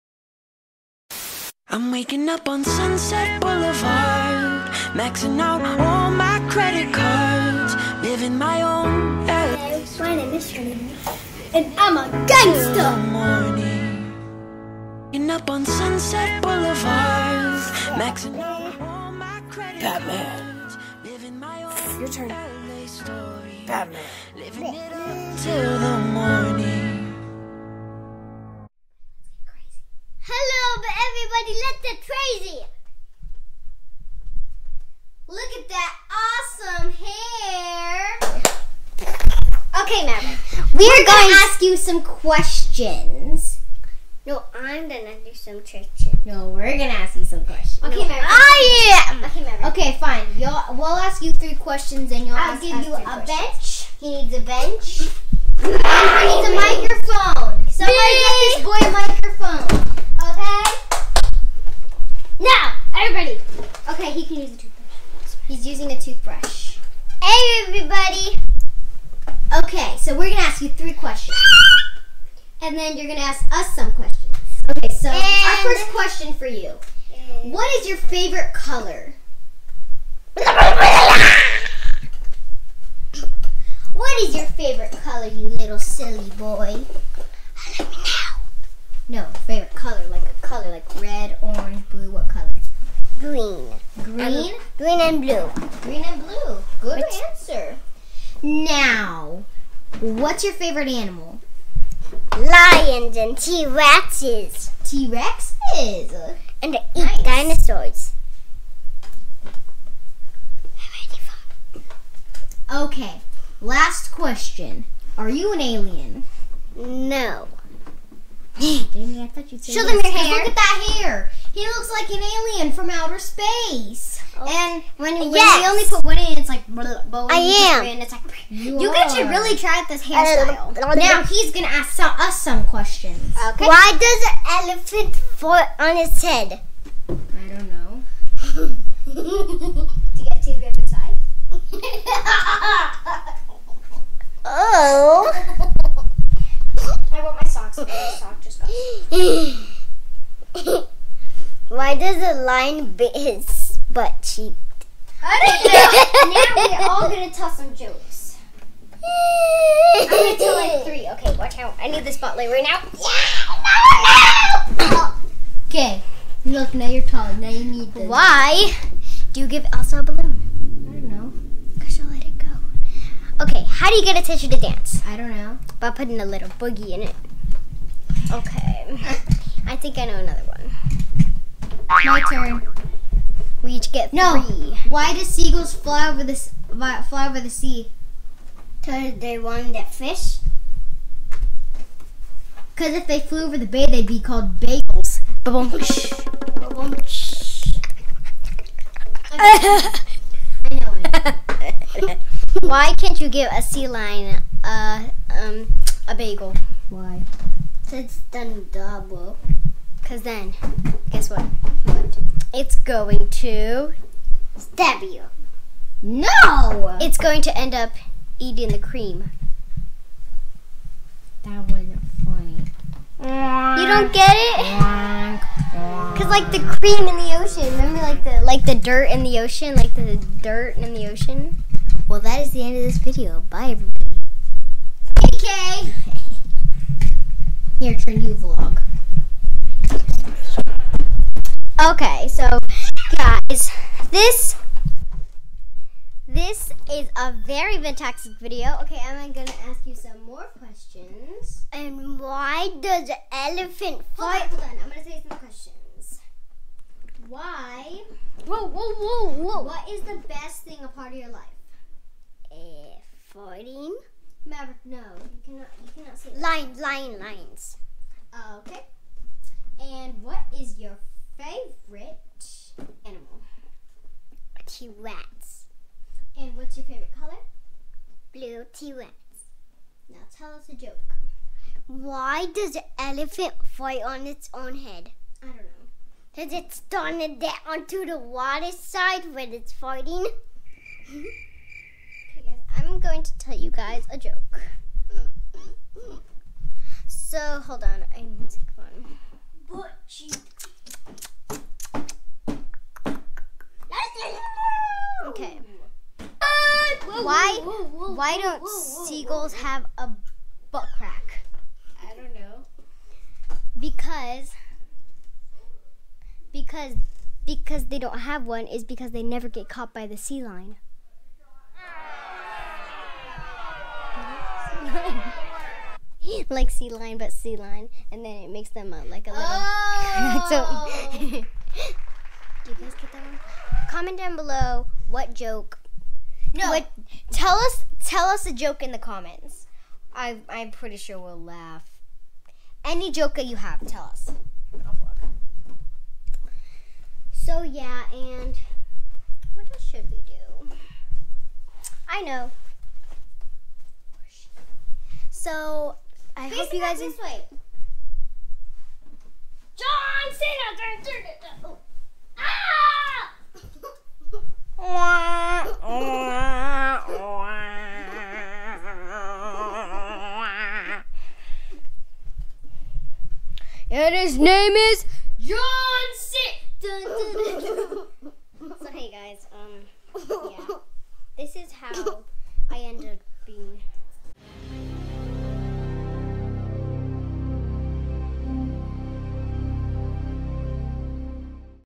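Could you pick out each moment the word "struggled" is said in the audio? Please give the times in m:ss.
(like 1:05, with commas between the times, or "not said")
not said.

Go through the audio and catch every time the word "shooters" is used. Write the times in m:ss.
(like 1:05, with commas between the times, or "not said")
not said.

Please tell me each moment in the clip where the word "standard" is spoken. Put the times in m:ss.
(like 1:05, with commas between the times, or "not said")
not said.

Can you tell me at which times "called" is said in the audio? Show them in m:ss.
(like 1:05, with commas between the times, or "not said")
3:14.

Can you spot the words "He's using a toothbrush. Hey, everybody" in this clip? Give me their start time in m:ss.
1:05.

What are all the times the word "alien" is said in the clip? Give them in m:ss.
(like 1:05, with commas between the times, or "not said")
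1:55, 2:02.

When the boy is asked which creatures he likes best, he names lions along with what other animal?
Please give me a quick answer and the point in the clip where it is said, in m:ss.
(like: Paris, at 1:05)
T Rexes, at 1:42.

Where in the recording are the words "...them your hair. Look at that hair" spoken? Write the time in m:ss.
1:59.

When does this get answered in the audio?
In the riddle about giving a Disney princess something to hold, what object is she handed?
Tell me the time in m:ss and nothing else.
2:49.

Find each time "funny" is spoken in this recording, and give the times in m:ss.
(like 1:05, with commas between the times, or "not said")
3:42.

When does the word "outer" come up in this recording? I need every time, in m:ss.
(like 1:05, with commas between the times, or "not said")
2:02.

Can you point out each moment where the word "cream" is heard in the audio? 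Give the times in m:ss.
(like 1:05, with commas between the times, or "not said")
3:38, 3:46.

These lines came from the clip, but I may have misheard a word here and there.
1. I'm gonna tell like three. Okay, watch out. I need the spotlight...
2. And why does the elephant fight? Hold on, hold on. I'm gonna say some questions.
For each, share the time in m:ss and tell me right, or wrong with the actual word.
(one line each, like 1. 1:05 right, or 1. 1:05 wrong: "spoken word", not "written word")
1. 2:40 right
2. 4:11 right.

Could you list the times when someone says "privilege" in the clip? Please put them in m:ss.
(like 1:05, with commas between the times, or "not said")
not said.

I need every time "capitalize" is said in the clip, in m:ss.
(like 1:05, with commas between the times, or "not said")
not said.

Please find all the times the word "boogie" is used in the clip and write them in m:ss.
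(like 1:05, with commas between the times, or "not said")
2:56.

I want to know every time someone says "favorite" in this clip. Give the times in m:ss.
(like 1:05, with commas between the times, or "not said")
1:17, 1:24, 1:29, 1:40, 4:36.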